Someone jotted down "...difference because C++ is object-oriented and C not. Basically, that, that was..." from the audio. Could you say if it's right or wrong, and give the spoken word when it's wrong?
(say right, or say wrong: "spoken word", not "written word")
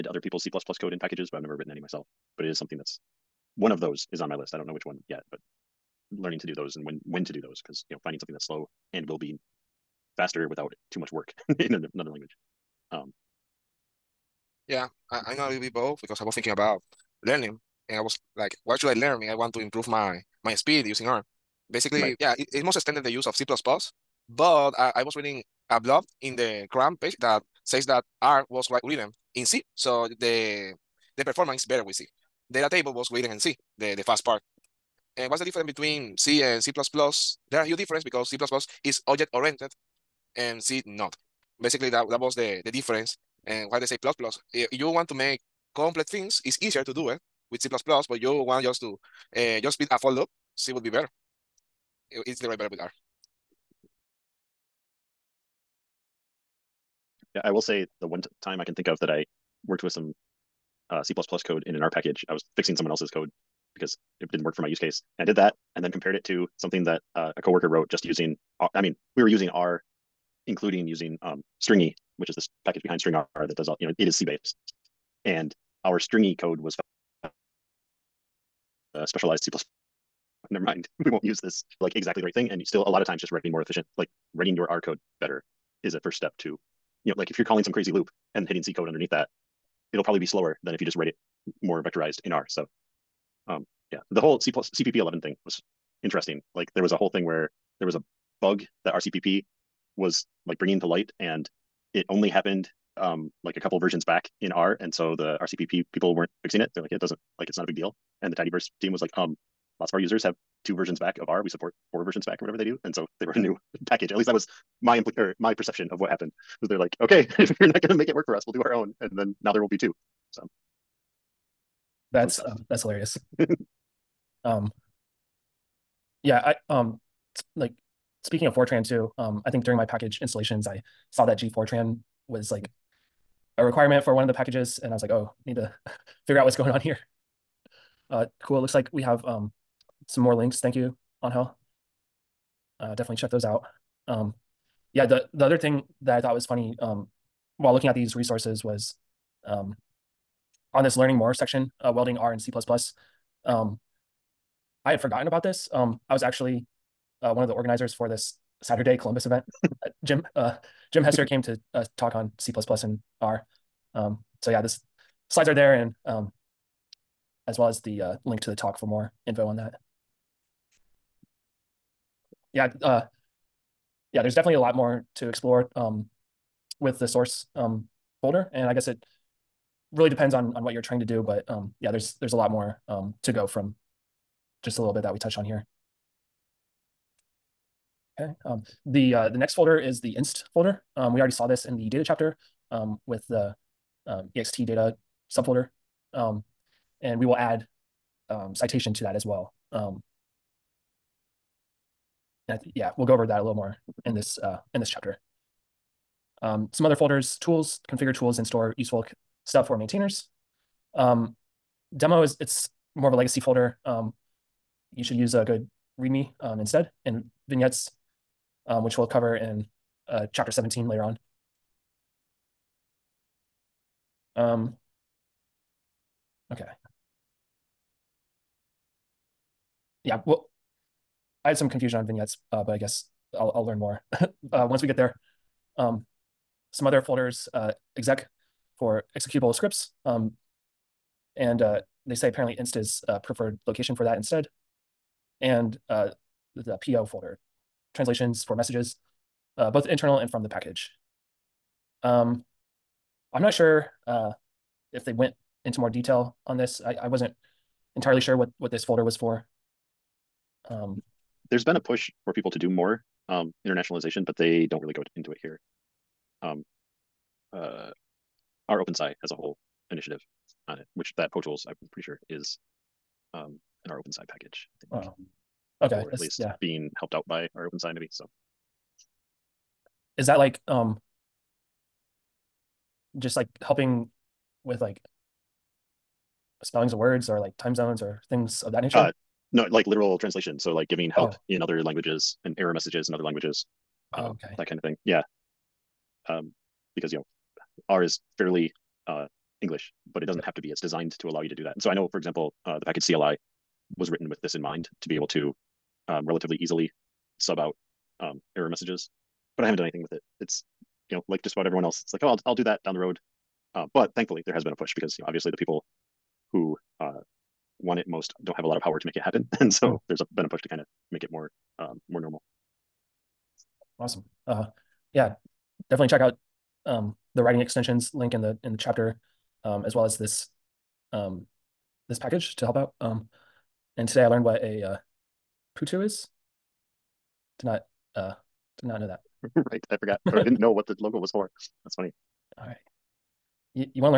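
right.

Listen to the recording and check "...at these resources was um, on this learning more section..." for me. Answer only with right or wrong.
right.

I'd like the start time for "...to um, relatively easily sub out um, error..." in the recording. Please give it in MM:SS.
05:05.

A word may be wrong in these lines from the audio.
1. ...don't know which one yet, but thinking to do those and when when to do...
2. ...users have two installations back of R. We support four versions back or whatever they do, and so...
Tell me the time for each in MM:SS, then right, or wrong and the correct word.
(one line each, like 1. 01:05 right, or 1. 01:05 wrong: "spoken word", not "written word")
1. 00:04 wrong: "learning", not "thinking"
2. 01:49 wrong: "versions", not "installations".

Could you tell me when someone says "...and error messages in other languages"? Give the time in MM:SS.
04:52.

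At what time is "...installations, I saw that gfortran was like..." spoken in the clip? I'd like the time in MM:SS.
02:10.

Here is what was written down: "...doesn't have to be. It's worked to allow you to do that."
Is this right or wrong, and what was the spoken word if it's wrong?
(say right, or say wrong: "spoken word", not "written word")
wrong: "designed", not "worked".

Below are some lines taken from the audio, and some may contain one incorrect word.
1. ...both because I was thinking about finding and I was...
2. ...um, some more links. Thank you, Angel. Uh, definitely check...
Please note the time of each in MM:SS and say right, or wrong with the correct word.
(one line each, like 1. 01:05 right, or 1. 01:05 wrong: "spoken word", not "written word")
1. 00:15 wrong: "learning", not "finding"
2. 02:19 right.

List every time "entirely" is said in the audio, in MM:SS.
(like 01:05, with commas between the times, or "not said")
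04:17.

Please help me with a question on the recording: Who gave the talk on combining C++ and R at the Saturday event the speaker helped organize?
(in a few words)
Jim Hester.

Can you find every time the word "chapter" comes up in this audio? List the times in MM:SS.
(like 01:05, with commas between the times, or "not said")
03:12, 03:24, 03:40, 05:28.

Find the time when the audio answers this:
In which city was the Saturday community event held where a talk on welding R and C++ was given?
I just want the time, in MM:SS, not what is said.
02:38.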